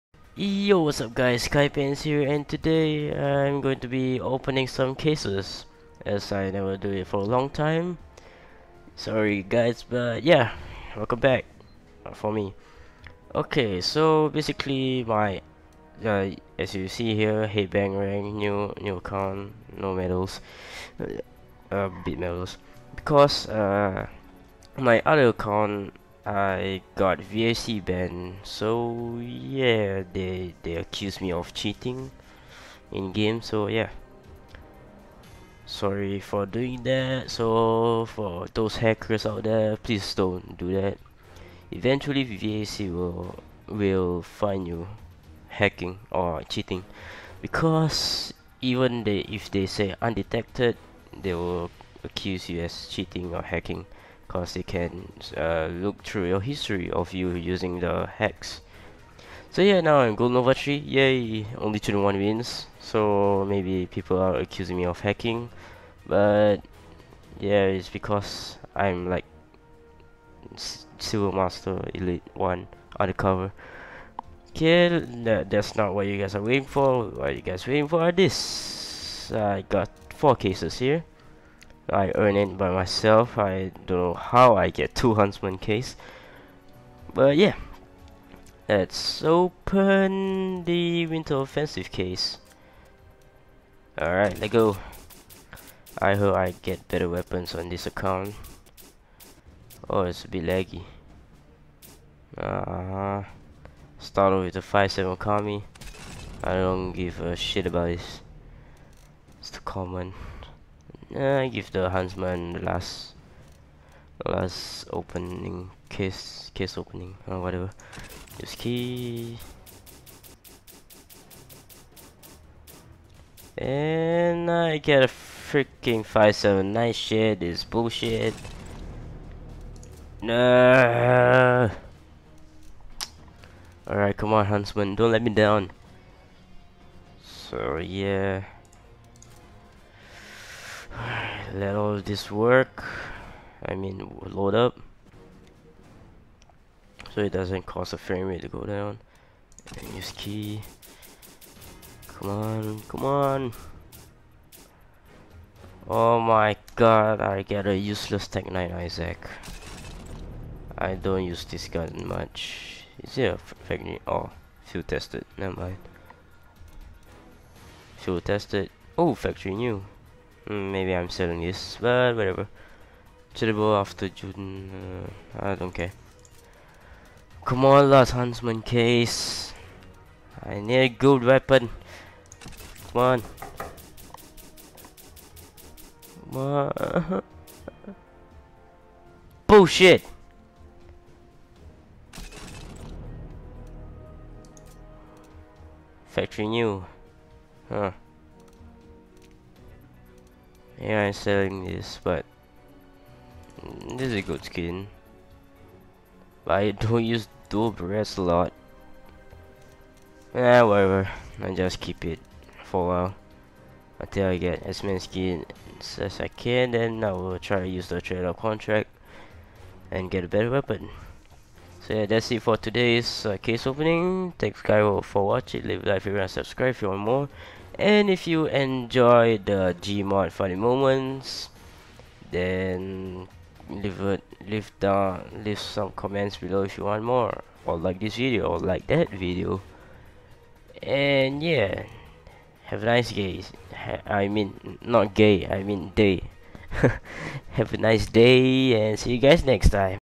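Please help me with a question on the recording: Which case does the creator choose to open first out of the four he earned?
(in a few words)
Winter Offensive case.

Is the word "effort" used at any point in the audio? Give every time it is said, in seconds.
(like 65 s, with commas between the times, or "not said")
not said.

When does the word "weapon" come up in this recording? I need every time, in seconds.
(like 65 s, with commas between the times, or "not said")
97 s, 181 s, 220 s.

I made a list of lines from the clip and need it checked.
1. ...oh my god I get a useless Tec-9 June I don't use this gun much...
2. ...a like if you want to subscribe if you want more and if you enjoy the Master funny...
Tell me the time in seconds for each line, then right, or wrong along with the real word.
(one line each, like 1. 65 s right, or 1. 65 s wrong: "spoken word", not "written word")
1. 155 s wrong: "Isaac", not "June"
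2. 225 s wrong: "Gmod", not "Master".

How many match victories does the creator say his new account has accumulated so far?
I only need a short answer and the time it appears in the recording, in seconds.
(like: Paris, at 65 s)
21, at 61 s.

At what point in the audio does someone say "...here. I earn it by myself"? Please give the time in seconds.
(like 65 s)
80 s.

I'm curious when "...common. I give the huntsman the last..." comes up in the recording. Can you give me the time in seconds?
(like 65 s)
109 s.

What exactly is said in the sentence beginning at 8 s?
Sorry guys, but yeah, welcome back uh, for me.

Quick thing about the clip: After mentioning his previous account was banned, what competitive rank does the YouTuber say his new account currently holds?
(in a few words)
Gold Nova 3.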